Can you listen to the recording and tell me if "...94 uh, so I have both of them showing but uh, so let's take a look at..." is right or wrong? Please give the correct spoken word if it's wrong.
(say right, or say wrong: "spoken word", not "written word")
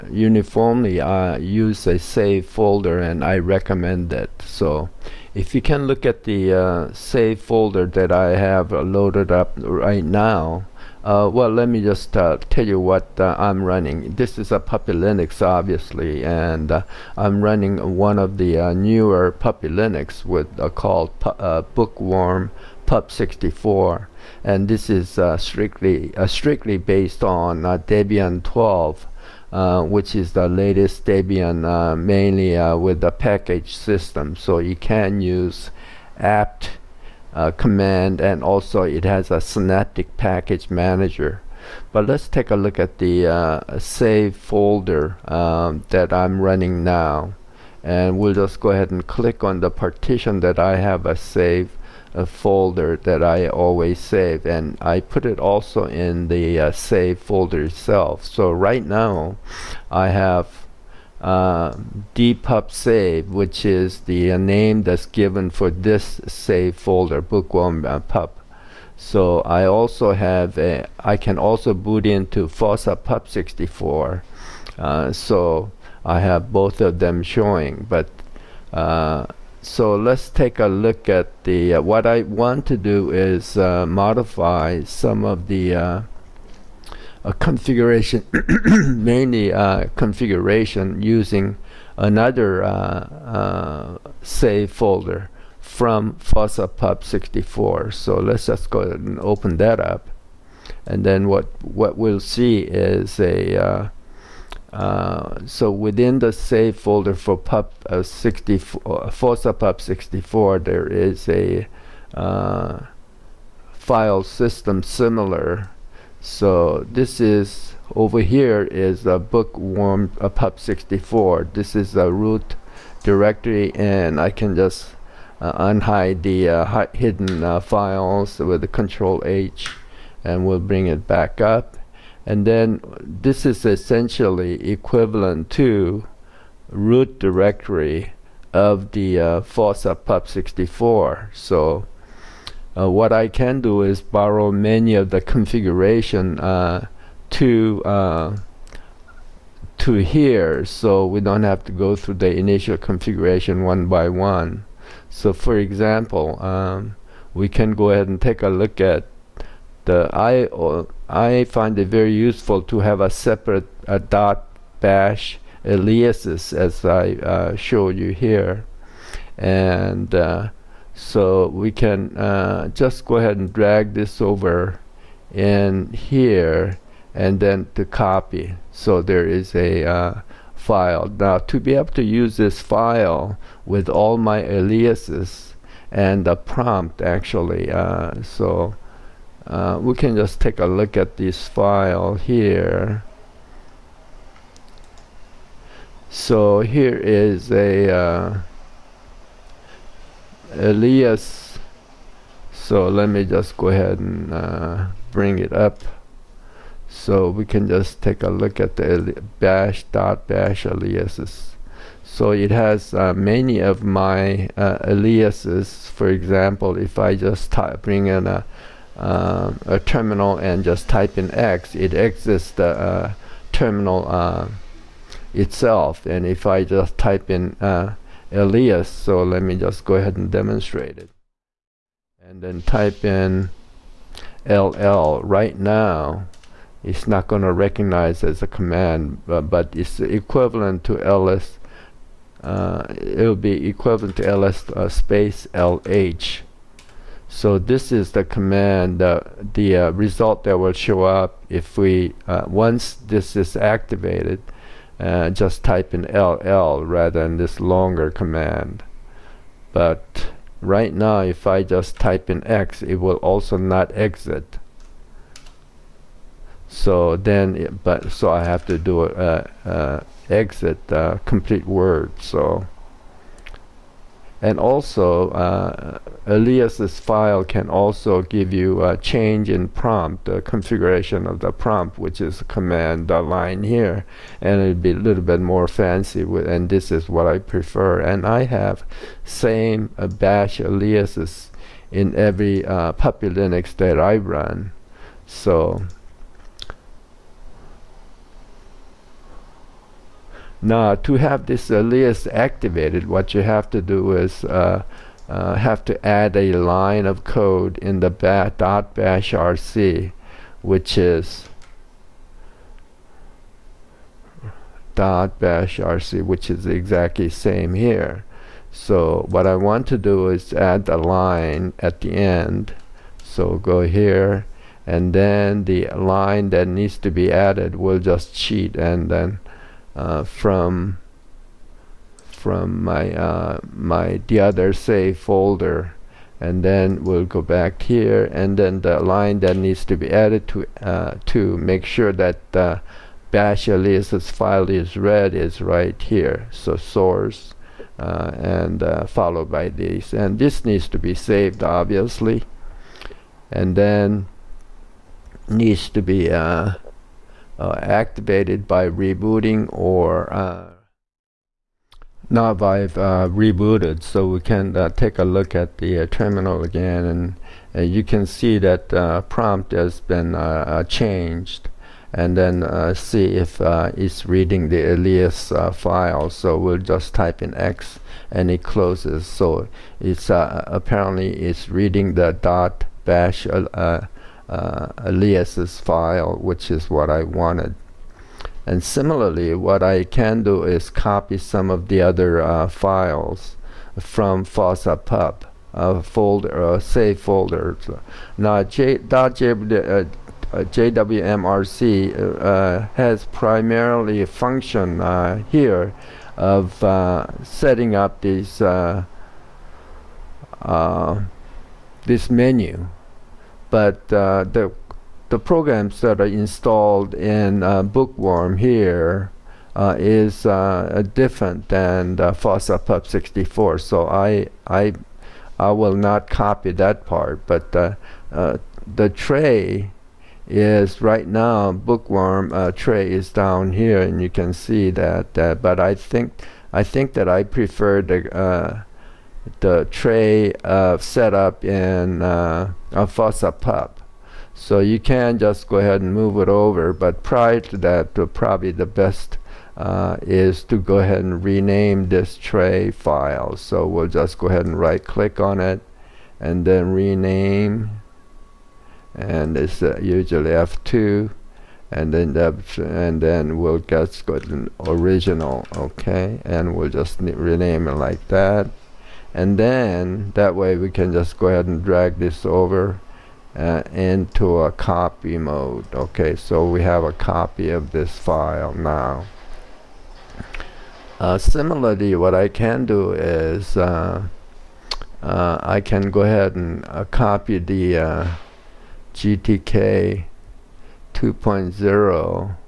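wrong: "64", not "94".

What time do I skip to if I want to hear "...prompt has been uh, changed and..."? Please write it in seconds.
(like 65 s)
369 s.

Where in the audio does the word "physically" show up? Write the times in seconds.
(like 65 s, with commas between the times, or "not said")
not said.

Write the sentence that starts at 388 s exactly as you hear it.
And similarly, what I can do is copy some of the other uh, files from Fossa Pup folder, uh, save folder.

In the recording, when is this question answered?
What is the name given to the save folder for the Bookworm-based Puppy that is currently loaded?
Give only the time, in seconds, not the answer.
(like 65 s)
62 s.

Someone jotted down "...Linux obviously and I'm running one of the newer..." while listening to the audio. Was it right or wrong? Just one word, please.
right.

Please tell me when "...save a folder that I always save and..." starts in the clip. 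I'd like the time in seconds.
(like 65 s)
51 s.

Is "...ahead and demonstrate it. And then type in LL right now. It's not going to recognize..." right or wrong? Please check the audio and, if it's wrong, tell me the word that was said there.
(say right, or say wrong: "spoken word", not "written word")
right.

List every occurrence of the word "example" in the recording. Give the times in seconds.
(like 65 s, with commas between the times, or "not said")
155 s, 216 s.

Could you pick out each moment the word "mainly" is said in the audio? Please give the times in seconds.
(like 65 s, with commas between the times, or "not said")
31 s, 88 s.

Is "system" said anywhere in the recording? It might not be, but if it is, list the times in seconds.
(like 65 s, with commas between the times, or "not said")
33 s, 114 s.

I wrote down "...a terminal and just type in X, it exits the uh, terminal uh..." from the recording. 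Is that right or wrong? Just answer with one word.
right.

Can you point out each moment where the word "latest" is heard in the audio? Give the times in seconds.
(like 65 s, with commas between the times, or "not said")
30 s.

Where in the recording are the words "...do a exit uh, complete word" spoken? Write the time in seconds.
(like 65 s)
268 s.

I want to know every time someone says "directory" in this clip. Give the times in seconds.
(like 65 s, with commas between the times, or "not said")
123 s, 137 s.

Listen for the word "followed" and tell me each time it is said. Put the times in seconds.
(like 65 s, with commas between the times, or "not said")
349 s.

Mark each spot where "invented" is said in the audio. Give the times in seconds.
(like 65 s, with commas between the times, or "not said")
not said.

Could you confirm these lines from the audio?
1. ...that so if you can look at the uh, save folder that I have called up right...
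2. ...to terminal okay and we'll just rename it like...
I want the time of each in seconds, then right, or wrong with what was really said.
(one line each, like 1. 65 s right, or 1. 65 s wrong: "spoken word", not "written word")
1. 4 s wrong: "loaded", not "called"
2. 464 s wrong: "original", not "terminal".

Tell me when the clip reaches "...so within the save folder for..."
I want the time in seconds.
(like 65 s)
105 s.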